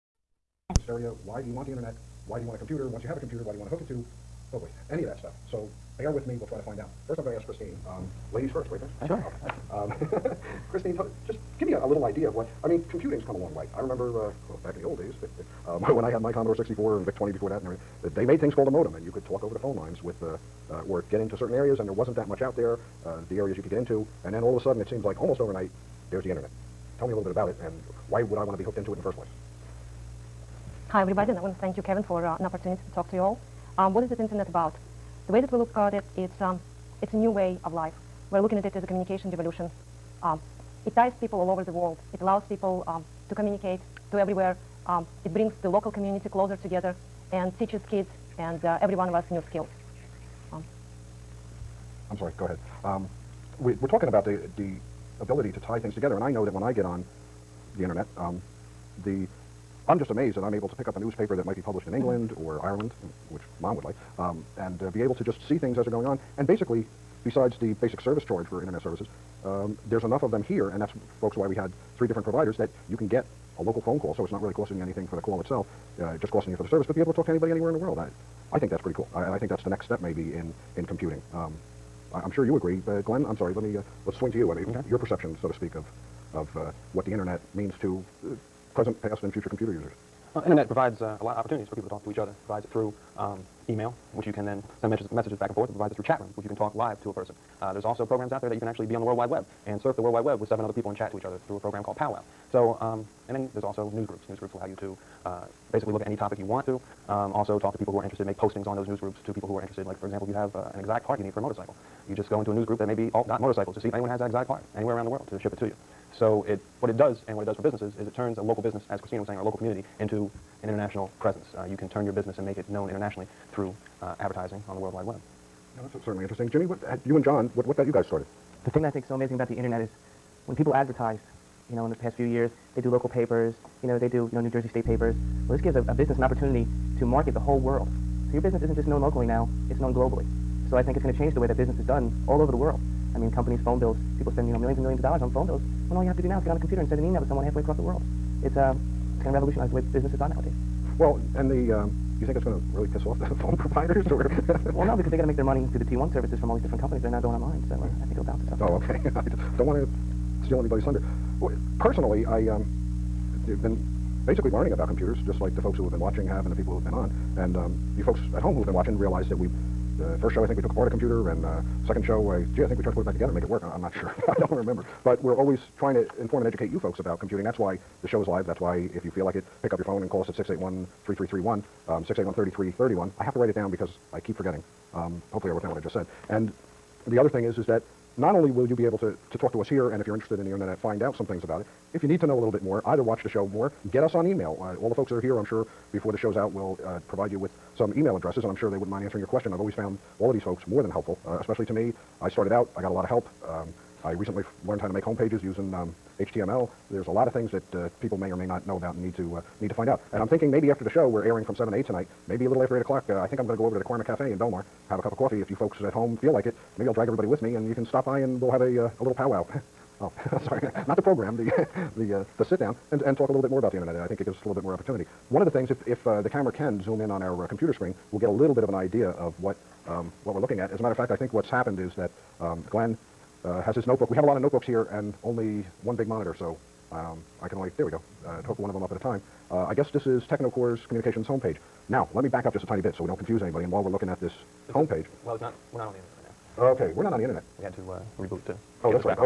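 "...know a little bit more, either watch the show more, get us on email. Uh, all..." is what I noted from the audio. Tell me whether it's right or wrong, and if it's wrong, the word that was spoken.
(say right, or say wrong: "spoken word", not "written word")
right.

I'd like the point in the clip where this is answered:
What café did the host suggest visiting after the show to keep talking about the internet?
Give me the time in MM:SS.
03:33.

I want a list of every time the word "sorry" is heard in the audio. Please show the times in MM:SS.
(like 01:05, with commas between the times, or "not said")
00:52, 01:23, 03:40.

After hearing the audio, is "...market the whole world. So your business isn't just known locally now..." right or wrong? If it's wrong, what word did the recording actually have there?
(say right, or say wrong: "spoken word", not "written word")
right.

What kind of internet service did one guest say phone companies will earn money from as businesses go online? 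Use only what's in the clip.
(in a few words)
T1 services.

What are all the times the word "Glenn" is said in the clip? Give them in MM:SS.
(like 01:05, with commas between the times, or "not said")
01:23, 03:52.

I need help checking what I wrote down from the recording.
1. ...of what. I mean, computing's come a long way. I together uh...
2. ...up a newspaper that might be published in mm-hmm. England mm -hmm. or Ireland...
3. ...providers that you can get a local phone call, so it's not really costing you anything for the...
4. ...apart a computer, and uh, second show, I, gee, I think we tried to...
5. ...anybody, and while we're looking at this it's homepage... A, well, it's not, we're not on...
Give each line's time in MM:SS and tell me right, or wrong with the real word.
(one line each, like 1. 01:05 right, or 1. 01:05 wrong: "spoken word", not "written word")
1. 00:12 wrong: "remember", not "together"
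2. 01:00 right
3. 01:12 right
4. 02:50 right
5. 04:03 right.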